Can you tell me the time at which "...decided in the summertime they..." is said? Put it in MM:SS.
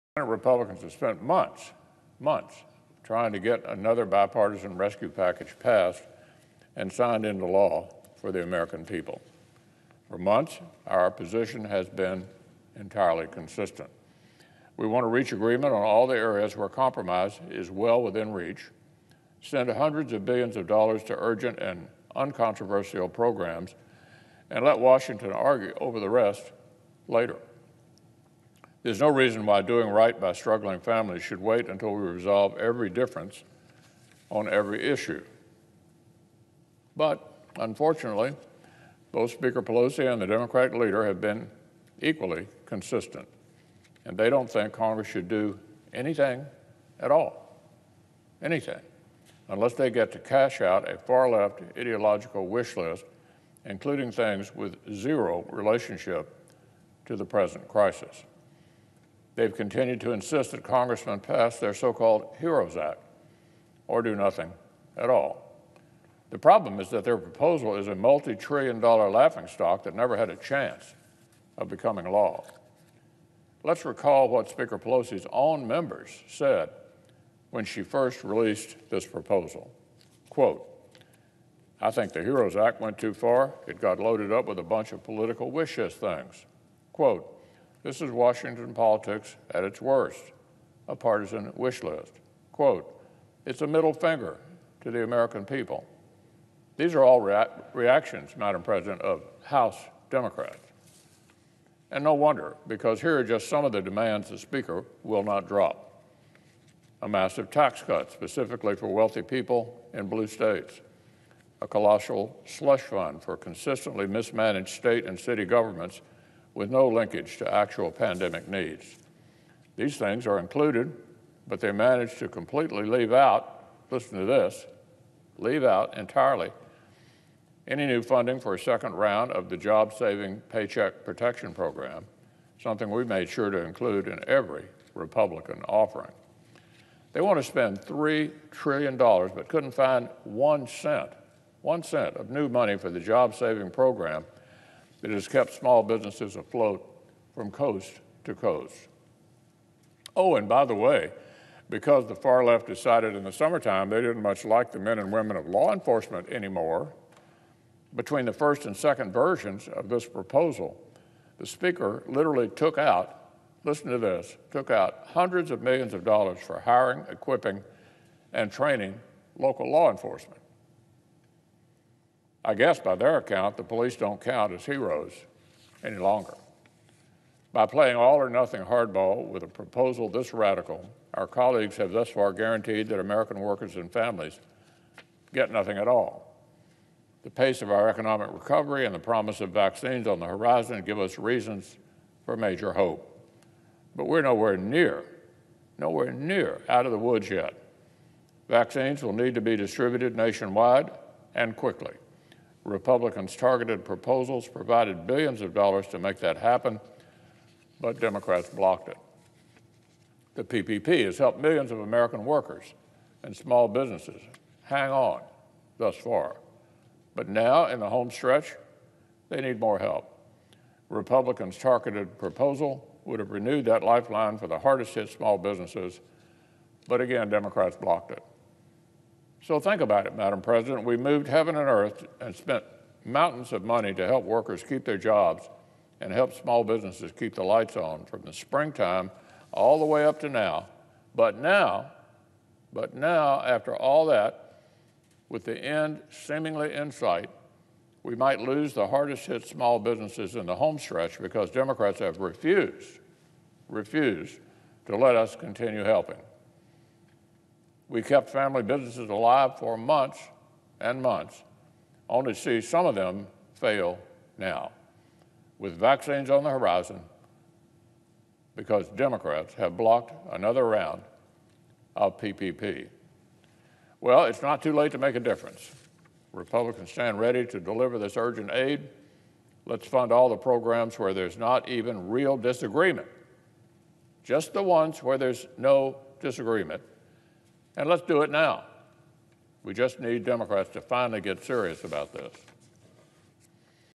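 02:32.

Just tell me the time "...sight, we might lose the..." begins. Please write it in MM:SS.
04:06.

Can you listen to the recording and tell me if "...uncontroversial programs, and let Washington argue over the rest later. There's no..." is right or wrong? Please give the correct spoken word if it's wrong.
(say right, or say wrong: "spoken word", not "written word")
right.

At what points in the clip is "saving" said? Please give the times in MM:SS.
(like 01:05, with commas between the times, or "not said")
02:09, 02:23.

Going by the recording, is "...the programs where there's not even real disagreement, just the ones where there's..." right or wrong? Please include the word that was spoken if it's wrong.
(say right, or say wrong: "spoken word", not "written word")
right.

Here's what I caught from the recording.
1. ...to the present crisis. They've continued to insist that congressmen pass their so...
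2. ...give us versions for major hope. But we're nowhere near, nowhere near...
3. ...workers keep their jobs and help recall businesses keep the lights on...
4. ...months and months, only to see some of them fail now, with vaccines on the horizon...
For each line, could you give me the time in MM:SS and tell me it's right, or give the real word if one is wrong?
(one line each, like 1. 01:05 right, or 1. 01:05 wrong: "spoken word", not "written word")
1. 00:57 right
2. 03:10 wrong: "reasons", not "versions"
3. 03:54 wrong: "small", not "recall"
4. 04:19 right.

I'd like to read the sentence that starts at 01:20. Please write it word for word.
Quote, I think the HEROES Act went too far.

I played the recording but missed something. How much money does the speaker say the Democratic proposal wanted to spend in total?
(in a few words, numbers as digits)
$3 trillion.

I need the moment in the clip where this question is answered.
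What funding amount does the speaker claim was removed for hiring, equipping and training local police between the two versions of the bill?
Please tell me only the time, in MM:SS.
02:45.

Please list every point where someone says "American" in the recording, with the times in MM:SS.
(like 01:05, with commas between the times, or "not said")
00:08, 01:35, 03:02, 03:31.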